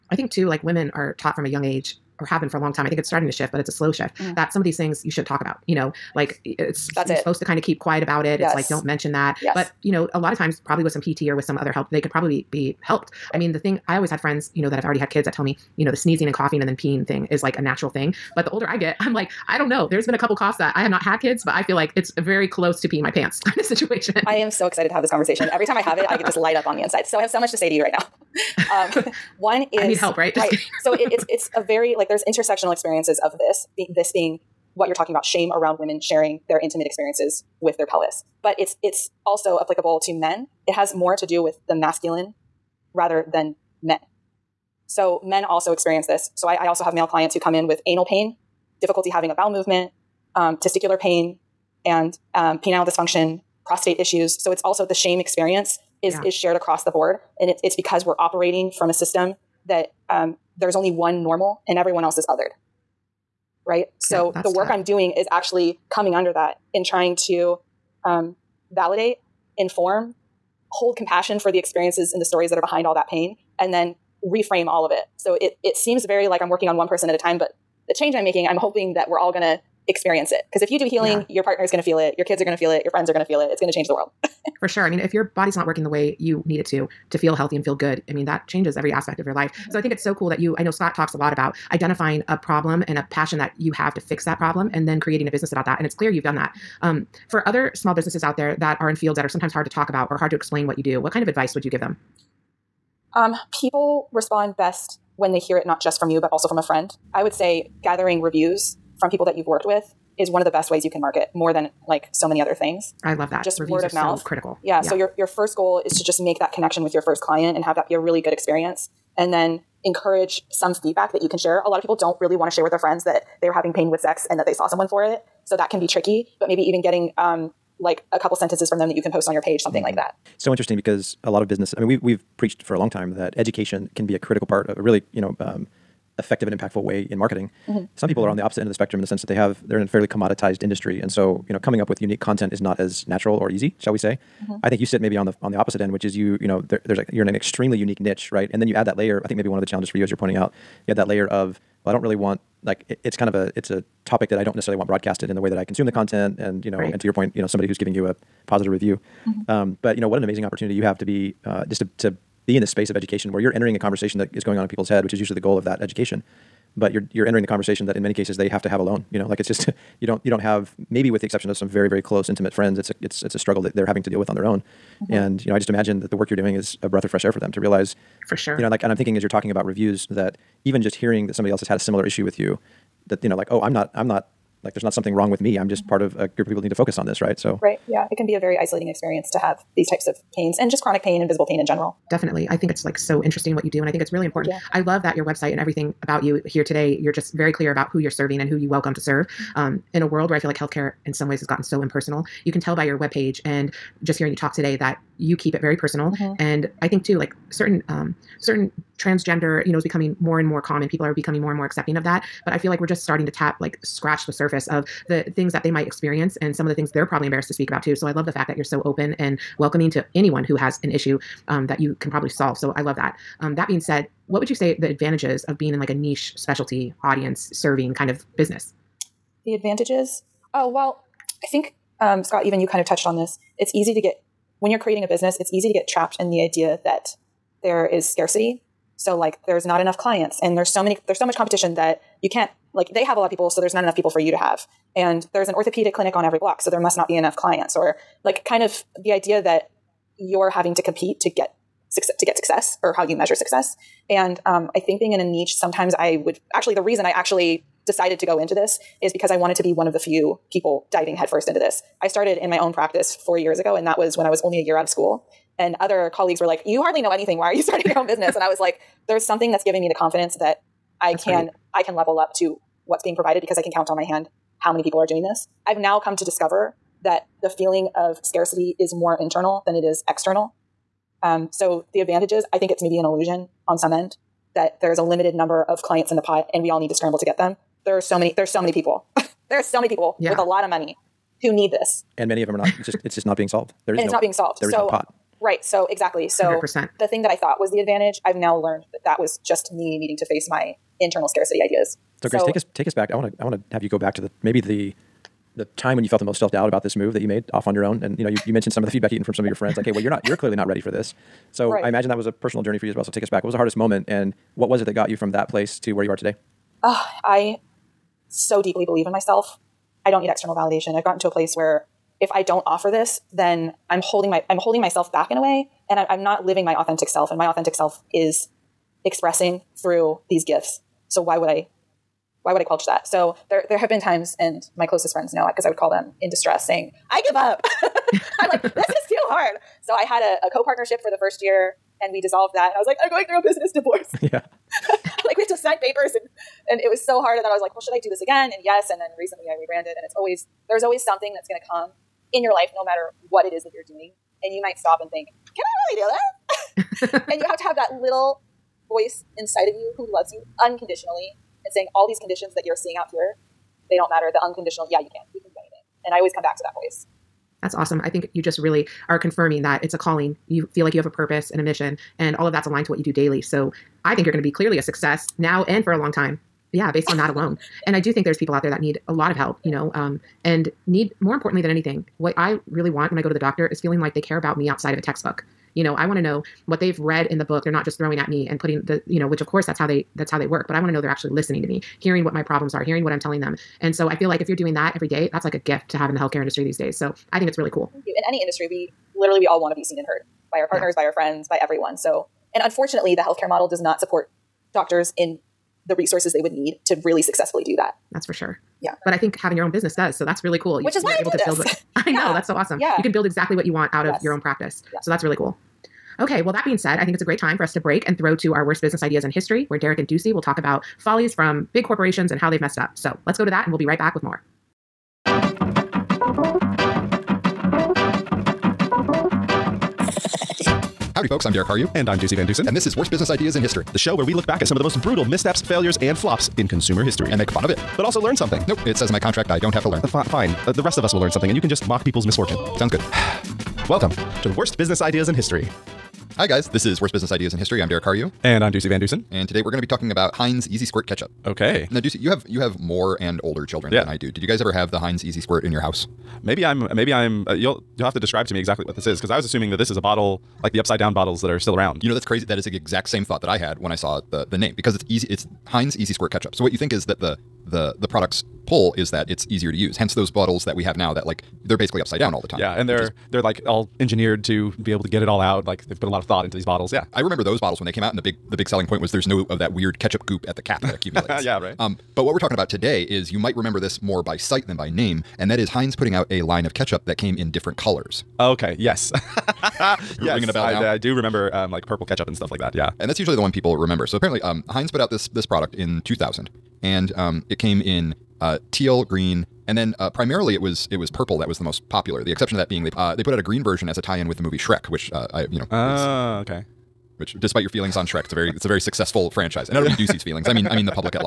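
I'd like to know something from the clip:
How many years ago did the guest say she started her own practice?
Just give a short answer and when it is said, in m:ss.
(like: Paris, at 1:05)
4, at 4:23.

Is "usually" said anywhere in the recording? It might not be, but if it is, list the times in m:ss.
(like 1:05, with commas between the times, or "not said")
2:45, 8:13.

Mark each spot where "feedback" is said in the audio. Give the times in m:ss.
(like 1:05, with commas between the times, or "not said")
2:00, 5:08.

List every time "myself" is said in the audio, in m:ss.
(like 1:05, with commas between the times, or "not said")
5:19, 5:24.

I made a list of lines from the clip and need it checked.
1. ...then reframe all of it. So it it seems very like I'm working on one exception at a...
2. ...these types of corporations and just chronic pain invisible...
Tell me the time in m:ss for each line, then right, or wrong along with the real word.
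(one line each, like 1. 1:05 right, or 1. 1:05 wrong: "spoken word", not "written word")
1. 1:13 wrong: "person", not "exception"
2. 3:09 wrong: "pains", not "corporations".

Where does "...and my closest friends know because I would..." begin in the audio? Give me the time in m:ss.
5:34.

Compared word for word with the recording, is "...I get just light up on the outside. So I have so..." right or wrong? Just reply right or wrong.
wrong.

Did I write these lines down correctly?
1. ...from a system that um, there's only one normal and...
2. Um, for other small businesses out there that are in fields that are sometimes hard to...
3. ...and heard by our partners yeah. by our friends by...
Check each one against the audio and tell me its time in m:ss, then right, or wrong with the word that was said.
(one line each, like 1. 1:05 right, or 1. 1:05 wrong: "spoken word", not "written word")
1. 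0:58 right
2. 1:36 right
3. 6:39 right.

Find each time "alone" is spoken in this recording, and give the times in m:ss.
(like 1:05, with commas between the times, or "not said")
2:48, 6:17.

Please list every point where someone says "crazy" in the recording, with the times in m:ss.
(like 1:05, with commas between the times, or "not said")
7:42.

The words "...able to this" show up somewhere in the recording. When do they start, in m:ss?
6:51.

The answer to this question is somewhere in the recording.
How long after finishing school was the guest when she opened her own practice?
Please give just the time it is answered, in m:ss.
4:24.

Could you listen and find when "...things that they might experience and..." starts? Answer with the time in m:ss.
3:35.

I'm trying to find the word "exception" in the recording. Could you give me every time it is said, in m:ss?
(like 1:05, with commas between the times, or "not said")
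2:51, 8:22.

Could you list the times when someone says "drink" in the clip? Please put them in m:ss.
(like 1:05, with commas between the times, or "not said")
not said.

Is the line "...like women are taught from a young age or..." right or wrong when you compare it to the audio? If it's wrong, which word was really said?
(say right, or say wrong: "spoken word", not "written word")
right.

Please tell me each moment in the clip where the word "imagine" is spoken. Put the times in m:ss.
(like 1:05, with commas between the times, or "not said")
2:55, 5:11.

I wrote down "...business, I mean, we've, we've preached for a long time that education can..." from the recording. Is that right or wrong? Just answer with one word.
right.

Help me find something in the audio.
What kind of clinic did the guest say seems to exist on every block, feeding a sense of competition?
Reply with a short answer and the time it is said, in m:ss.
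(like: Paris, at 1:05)
Orthopedic clinic, at 4:05.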